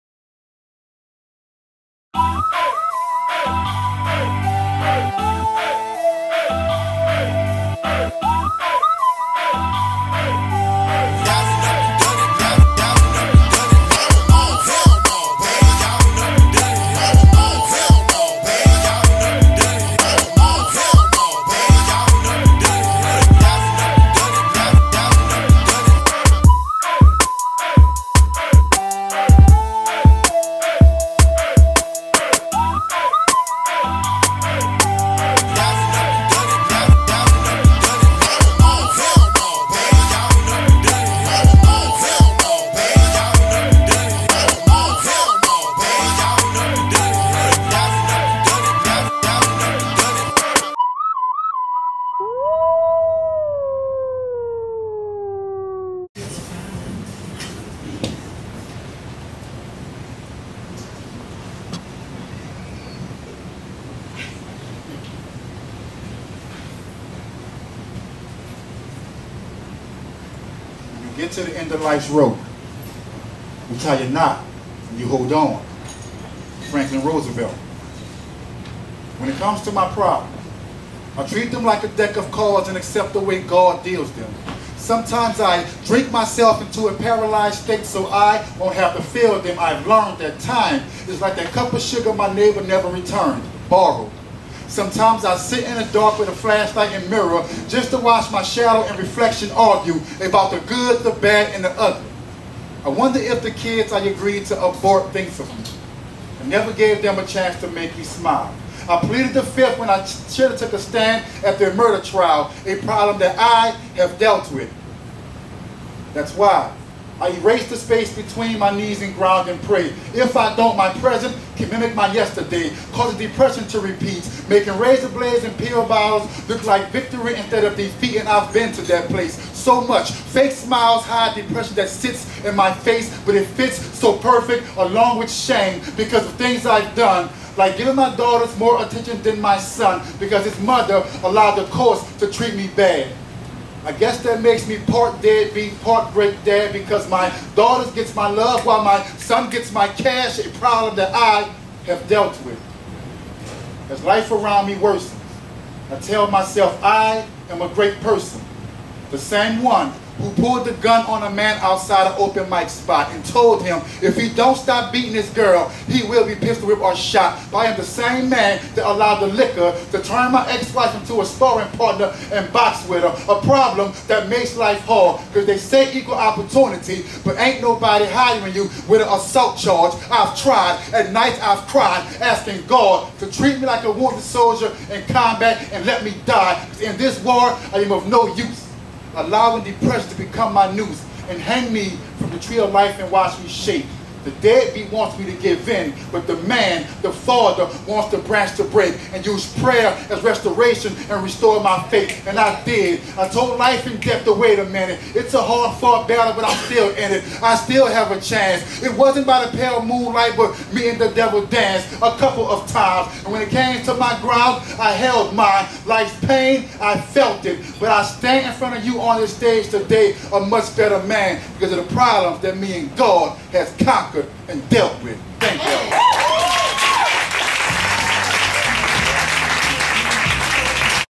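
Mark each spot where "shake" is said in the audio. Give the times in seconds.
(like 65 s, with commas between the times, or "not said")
193 s.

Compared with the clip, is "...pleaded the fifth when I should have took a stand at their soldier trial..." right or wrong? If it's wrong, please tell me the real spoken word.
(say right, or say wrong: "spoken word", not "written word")
wrong: "murder", not "soldier".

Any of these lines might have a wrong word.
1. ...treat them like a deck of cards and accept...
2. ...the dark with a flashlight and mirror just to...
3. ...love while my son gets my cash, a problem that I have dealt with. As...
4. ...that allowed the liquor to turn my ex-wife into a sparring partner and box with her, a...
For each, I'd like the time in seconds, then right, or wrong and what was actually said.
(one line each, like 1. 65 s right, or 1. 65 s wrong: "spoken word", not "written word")
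1. 81 s right
2. 95 s right
3. 148 s right
4. 168 s right.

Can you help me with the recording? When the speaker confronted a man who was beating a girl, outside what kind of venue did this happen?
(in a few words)
open mic spot.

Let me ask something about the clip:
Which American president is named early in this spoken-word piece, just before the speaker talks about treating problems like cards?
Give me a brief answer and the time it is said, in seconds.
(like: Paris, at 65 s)
Franklin Roosevelt, at 76 s.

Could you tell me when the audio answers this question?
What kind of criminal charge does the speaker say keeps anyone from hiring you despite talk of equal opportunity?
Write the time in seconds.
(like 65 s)
179 s.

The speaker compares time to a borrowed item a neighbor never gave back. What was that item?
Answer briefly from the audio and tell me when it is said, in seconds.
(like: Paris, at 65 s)
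cup of sugar, at 91 s.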